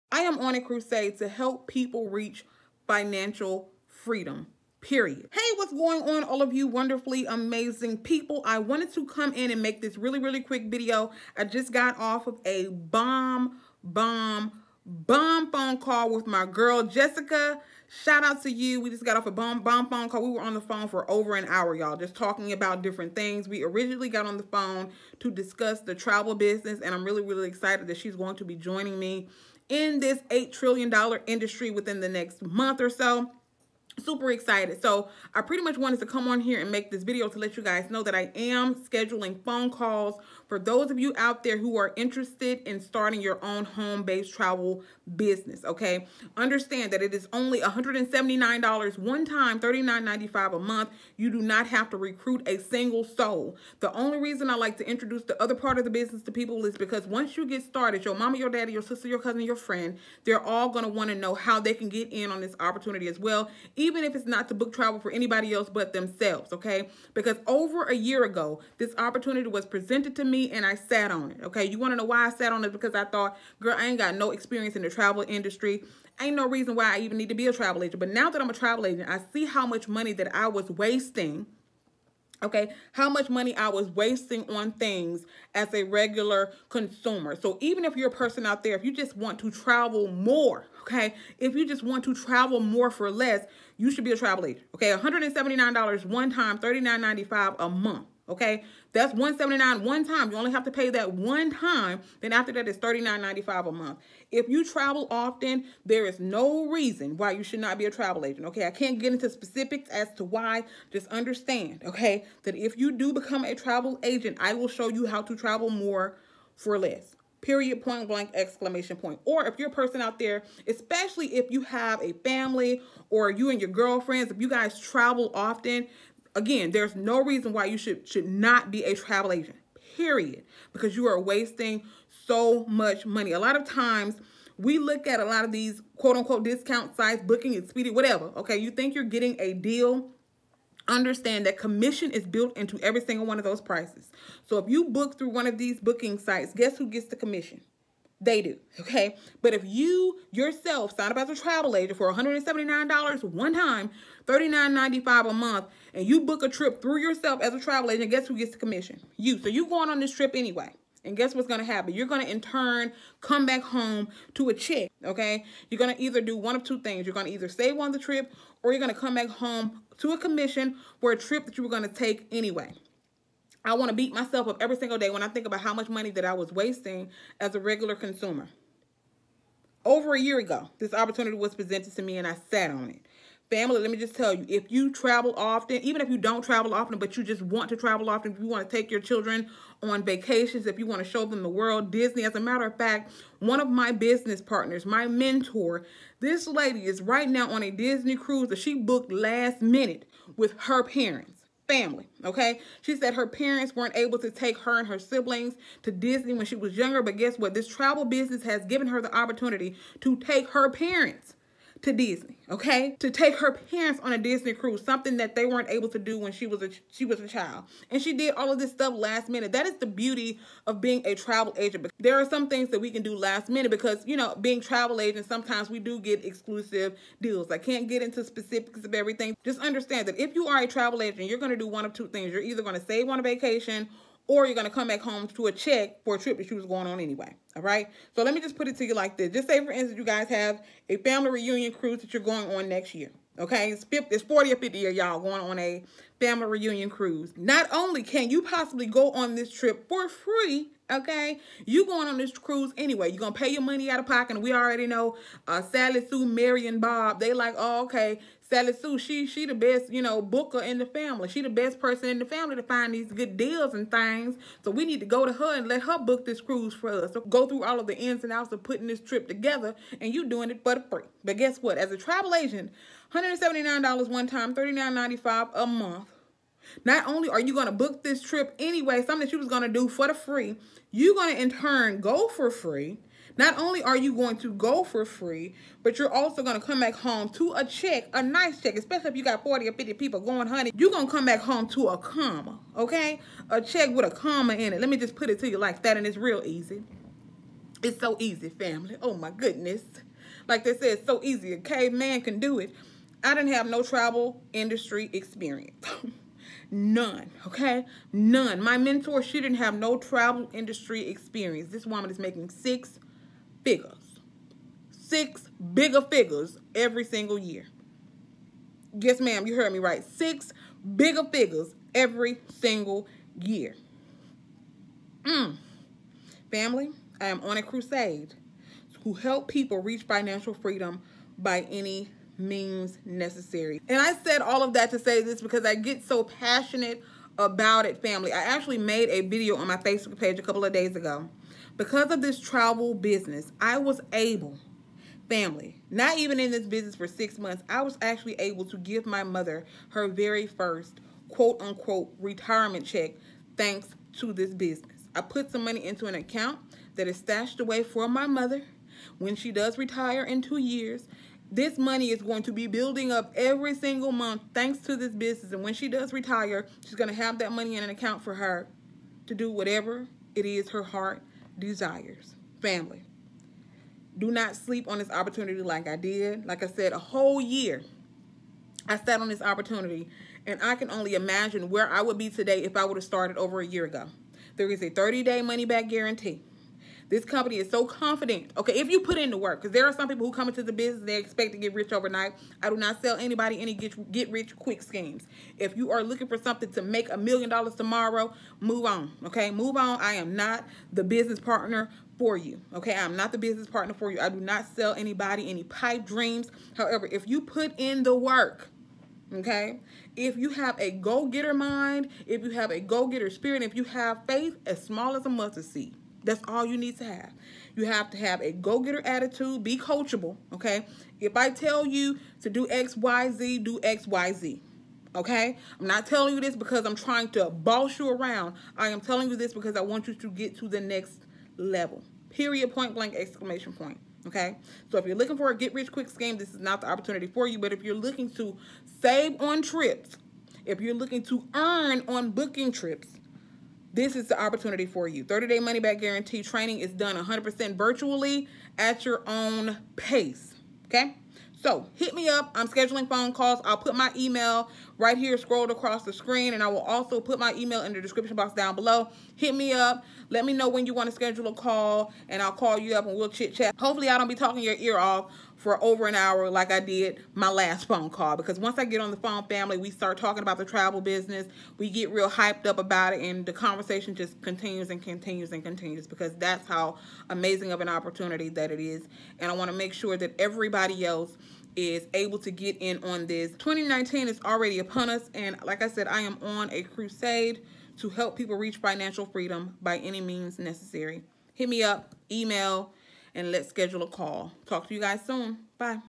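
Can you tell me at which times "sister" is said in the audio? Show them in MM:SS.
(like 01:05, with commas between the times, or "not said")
00:58.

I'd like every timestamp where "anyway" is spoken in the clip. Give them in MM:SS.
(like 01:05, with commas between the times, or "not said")
02:40, 02:52, 03:56, 04:12, 04:38.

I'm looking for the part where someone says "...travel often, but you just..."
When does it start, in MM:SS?
03:06.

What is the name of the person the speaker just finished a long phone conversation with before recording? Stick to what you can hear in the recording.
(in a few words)
Jessica.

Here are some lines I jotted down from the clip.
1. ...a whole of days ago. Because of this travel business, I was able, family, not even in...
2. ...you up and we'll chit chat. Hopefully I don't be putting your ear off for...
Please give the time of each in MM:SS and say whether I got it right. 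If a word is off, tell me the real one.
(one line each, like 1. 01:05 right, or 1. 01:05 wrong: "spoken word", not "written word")
1. 05:40 wrong: "couple", not "whole"
2. 07:42 wrong: "talking", not "putting".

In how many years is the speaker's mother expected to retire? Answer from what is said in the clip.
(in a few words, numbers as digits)
2 years.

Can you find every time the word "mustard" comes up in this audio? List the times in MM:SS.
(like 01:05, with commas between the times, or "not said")
06:55.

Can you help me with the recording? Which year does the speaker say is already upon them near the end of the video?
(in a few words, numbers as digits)
2019.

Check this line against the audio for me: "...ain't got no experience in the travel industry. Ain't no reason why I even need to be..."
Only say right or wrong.
right.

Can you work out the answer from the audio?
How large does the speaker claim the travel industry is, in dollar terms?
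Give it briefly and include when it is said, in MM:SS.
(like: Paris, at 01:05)
$8 trillion, at 00:30.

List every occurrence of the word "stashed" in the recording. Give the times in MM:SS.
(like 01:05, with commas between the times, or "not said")
05:57.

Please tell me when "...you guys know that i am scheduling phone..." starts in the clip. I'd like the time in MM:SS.
00:37.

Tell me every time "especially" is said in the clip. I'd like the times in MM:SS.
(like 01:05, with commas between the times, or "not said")
02:00, 04:48.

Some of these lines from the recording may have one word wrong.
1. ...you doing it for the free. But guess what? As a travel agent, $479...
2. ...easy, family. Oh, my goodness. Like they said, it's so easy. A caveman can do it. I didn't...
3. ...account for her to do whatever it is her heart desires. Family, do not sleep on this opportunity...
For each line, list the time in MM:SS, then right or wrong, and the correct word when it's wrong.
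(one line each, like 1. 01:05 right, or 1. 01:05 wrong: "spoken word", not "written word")
1. 04:30 wrong: "179", not "479"
2. 04:58 right
3. 06:07 right.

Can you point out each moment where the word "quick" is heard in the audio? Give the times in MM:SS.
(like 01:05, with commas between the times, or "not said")
00:10, 06:34, 07:15.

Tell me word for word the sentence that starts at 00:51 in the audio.
You do not have to recruit a single soul.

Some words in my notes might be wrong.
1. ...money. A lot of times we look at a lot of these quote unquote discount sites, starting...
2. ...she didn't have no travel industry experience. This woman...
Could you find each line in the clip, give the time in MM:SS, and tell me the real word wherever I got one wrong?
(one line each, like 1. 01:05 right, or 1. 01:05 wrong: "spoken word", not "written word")
1. 02:13 wrong: "booking", not "starting"
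2. 05:09 right.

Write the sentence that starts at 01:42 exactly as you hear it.
Then after that, it's 39.95 a month.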